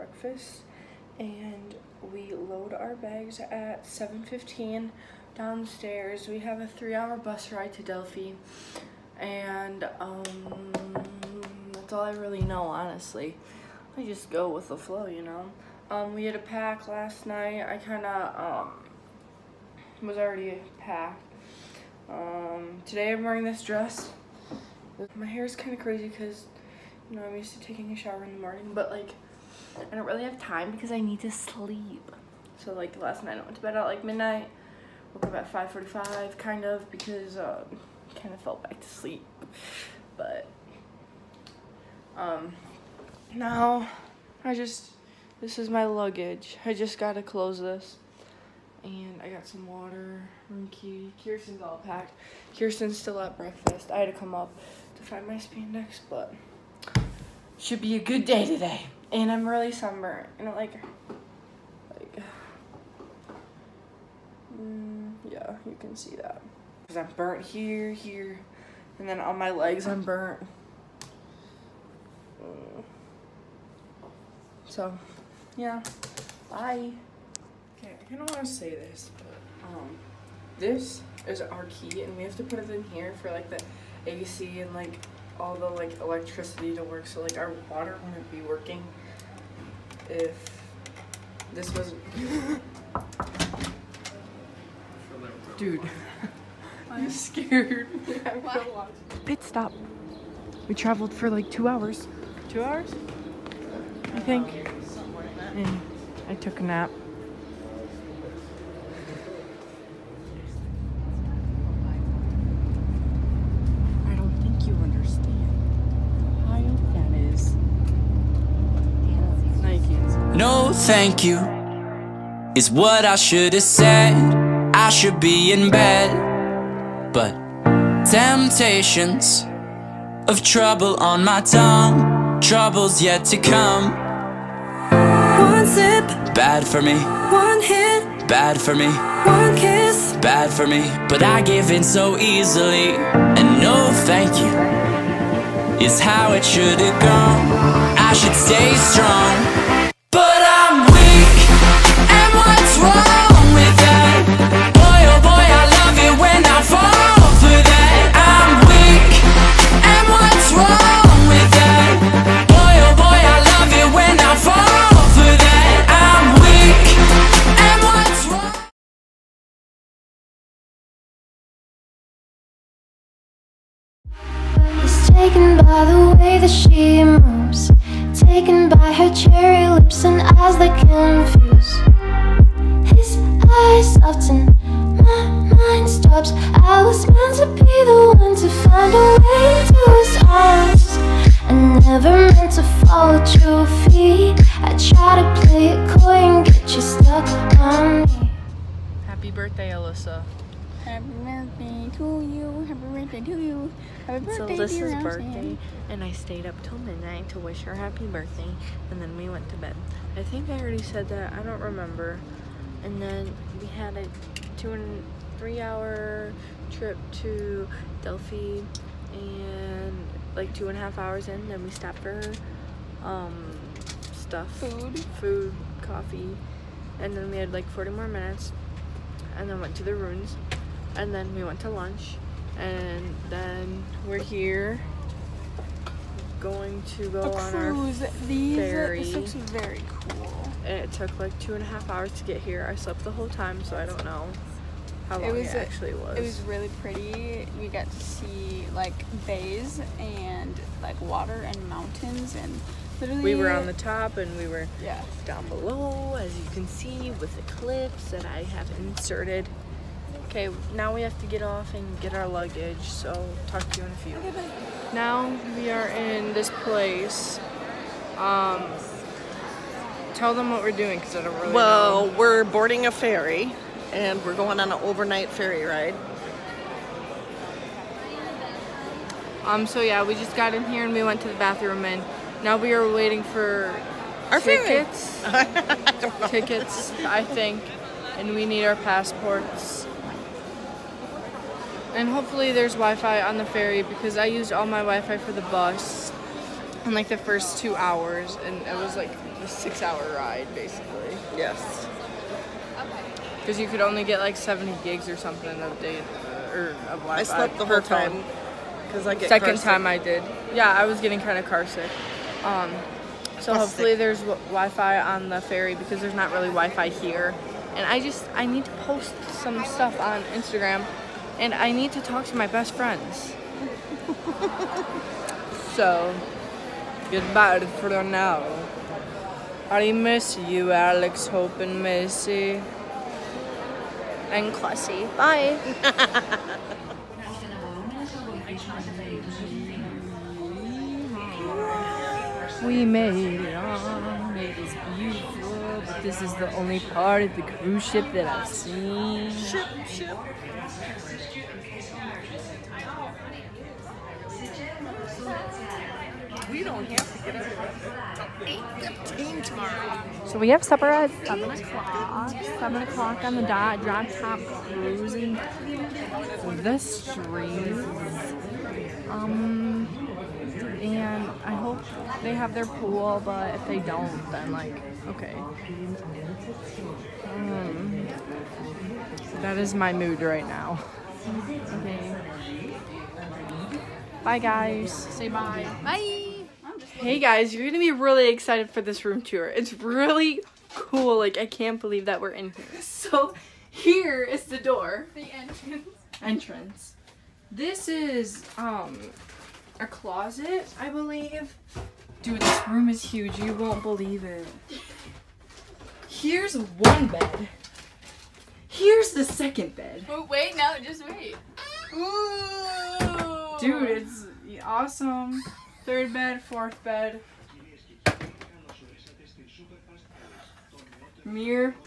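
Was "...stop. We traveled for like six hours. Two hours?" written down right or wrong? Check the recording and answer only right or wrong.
wrong.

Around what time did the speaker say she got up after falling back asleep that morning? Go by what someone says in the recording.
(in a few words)
5:45.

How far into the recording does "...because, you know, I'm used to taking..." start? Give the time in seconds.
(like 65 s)
26 s.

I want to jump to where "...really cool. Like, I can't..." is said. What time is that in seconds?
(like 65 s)
389 s.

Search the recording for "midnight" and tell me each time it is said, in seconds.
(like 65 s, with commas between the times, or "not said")
34 s, 206 s.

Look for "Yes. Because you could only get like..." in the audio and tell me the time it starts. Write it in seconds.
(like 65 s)
301 s.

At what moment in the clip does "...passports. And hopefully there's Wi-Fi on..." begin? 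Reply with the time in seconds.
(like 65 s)
288 s.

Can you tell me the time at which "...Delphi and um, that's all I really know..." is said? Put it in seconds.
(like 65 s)
7 s.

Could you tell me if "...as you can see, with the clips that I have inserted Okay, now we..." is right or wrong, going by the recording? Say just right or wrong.
right.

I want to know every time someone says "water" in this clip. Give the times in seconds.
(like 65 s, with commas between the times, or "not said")
49 s, 87 s, 251 s.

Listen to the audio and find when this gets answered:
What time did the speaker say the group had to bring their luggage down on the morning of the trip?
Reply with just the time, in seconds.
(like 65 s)
3 s.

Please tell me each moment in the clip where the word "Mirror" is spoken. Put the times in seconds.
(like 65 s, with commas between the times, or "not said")
421 s.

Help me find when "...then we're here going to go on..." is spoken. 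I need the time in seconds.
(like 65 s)
233 s.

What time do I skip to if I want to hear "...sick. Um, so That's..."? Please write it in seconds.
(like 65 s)
311 s.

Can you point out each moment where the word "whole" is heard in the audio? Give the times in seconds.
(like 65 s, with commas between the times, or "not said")
243 s, 307 s.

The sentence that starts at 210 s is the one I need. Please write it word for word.
I think I already said that.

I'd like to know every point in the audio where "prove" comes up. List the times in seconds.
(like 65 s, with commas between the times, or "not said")
not said.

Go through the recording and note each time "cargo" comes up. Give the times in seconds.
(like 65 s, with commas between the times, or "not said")
not said.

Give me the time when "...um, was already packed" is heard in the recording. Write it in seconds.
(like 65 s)
18 s.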